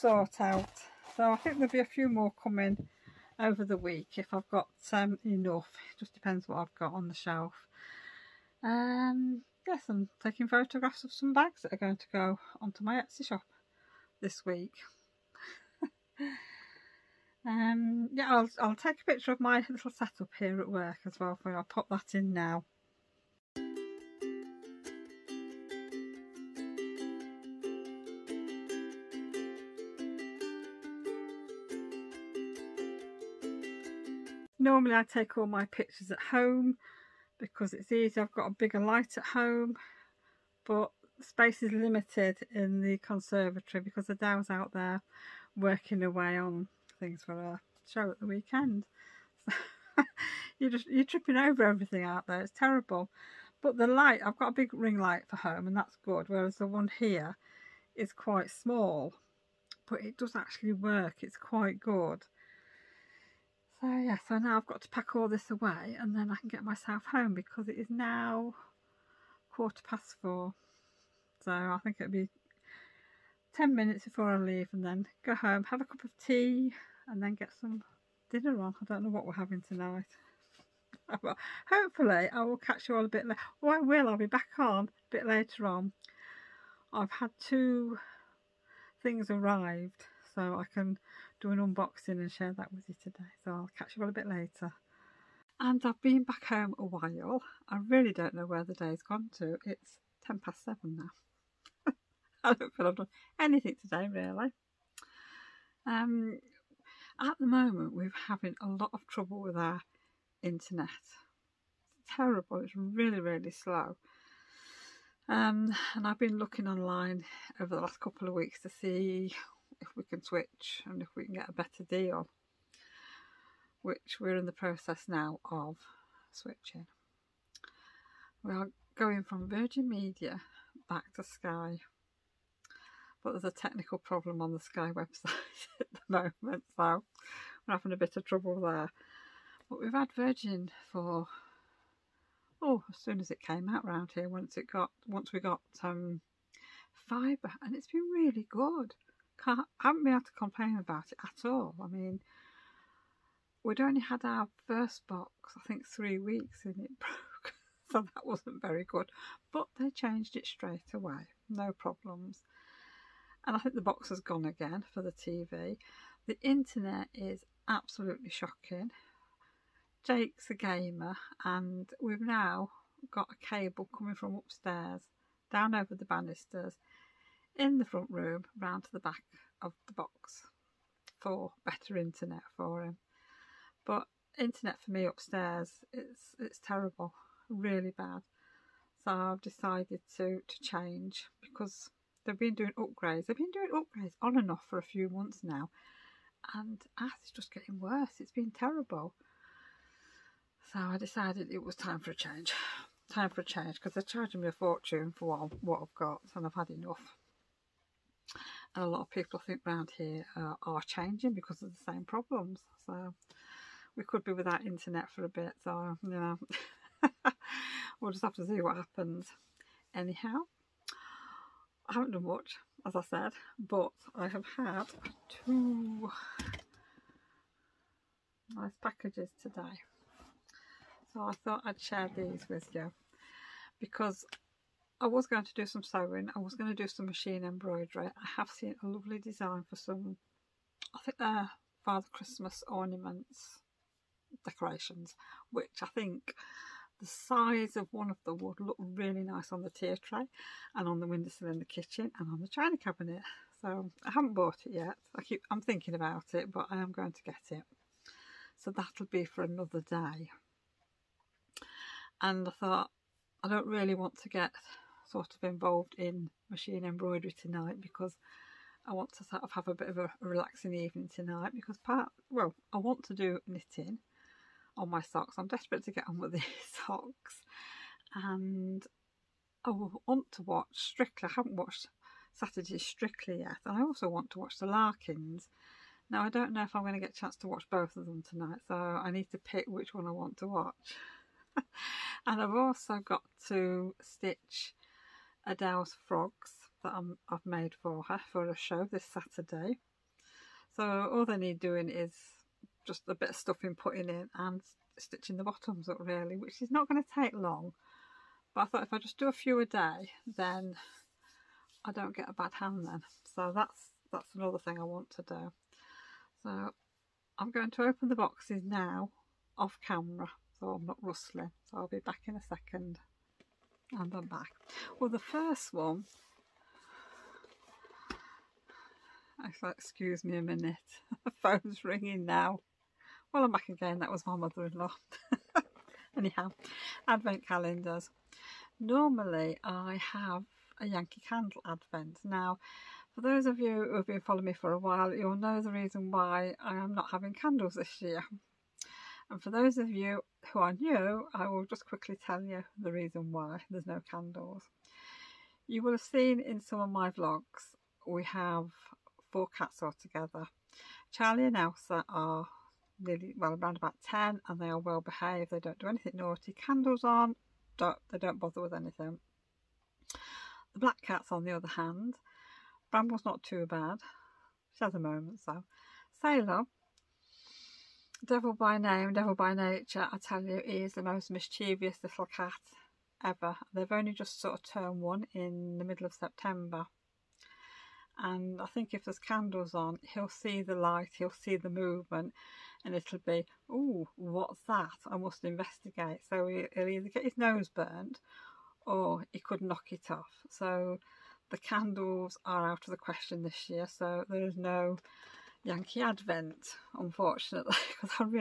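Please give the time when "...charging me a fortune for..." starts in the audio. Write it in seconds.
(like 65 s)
204 s.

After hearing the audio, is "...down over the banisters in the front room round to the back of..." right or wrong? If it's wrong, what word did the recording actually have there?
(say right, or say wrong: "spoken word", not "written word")
right.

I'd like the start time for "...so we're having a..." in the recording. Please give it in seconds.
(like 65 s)
136 s.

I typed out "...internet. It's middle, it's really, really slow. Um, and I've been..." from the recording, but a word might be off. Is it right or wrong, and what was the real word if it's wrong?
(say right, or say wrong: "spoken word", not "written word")
wrong: "terrible", not "middle".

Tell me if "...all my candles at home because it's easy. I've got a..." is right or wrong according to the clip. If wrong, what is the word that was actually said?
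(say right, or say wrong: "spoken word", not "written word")
wrong: "pictures", not "candles".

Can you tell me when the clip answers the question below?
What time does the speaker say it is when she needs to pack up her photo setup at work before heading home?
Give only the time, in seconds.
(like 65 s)
69 s.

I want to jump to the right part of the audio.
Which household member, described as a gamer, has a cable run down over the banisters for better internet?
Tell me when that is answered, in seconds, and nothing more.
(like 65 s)
170 s.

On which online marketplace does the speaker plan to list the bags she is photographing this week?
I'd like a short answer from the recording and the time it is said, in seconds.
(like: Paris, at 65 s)
Etsy, at 13 s.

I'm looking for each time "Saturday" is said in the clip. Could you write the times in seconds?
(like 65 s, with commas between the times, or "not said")
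282 s, 299 s.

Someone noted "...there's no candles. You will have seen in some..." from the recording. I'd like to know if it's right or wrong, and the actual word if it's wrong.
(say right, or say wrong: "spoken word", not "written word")
right.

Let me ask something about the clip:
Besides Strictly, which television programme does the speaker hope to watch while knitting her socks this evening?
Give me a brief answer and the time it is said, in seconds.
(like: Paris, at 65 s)
The Larkins, at 284 s.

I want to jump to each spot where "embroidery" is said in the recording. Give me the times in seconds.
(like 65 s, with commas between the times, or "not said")
237 s, 266 s.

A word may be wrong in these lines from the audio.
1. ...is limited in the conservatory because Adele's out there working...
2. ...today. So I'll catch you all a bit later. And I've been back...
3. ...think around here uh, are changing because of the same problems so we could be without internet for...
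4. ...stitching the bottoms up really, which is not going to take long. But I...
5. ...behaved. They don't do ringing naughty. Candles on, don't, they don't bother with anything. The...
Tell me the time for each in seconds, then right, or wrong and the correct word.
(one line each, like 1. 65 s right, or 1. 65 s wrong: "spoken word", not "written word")
1. 41 s right
2. 93 s right
3. 209 s right
4. 304 s right
5. 365 s wrong: "anything", not "ringing".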